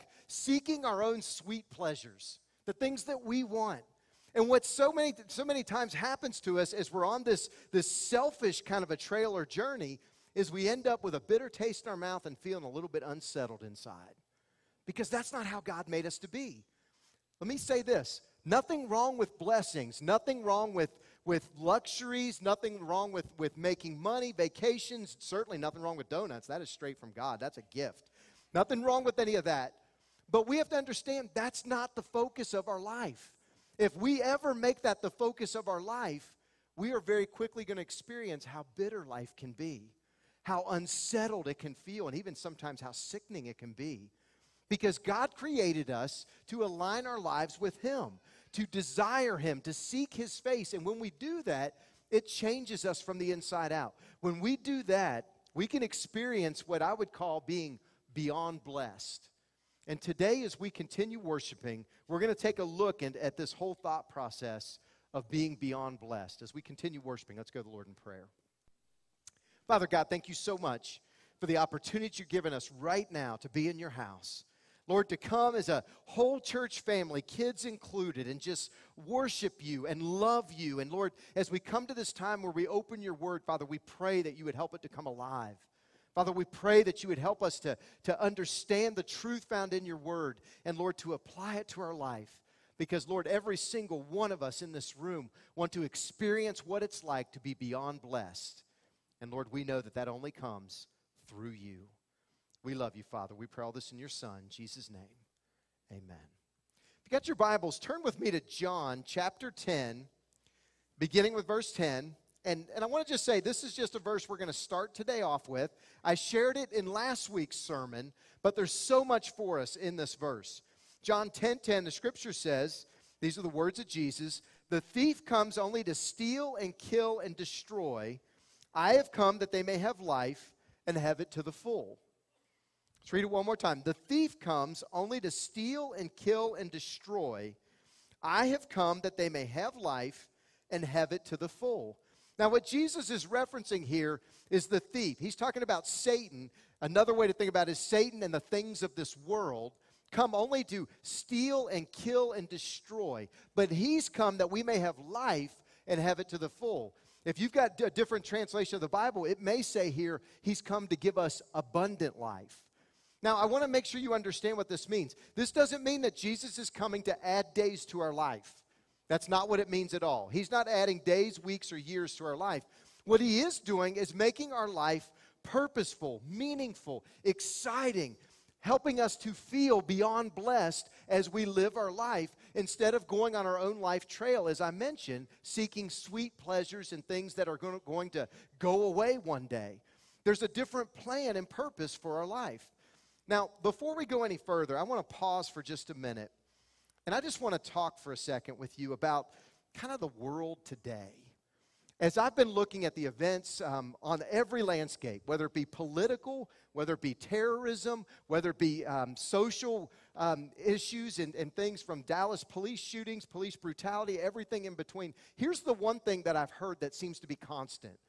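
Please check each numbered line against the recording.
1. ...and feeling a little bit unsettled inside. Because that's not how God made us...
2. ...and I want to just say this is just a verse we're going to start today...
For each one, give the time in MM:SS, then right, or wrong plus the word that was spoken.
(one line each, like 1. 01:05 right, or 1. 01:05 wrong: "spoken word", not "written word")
1. 00:12 right
2. 01:52 right.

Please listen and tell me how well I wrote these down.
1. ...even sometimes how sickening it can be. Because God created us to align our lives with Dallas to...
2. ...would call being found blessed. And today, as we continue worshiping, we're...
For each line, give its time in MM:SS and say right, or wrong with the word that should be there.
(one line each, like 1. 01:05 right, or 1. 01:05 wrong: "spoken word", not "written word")
1. 00:42 wrong: "Him", not "Dallas"
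2. 00:56 wrong: "beyond", not "found".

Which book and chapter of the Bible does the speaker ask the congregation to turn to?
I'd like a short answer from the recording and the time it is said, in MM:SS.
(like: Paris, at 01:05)
John chapter 10, at 01:48.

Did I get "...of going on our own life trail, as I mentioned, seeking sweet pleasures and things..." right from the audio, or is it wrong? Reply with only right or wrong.
right.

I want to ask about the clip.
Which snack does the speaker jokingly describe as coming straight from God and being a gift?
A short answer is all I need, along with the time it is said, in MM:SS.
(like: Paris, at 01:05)
donuts, at 00:26.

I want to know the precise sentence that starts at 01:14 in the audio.
Lord, to come as a whole church family, kids included, and just worship you and love you.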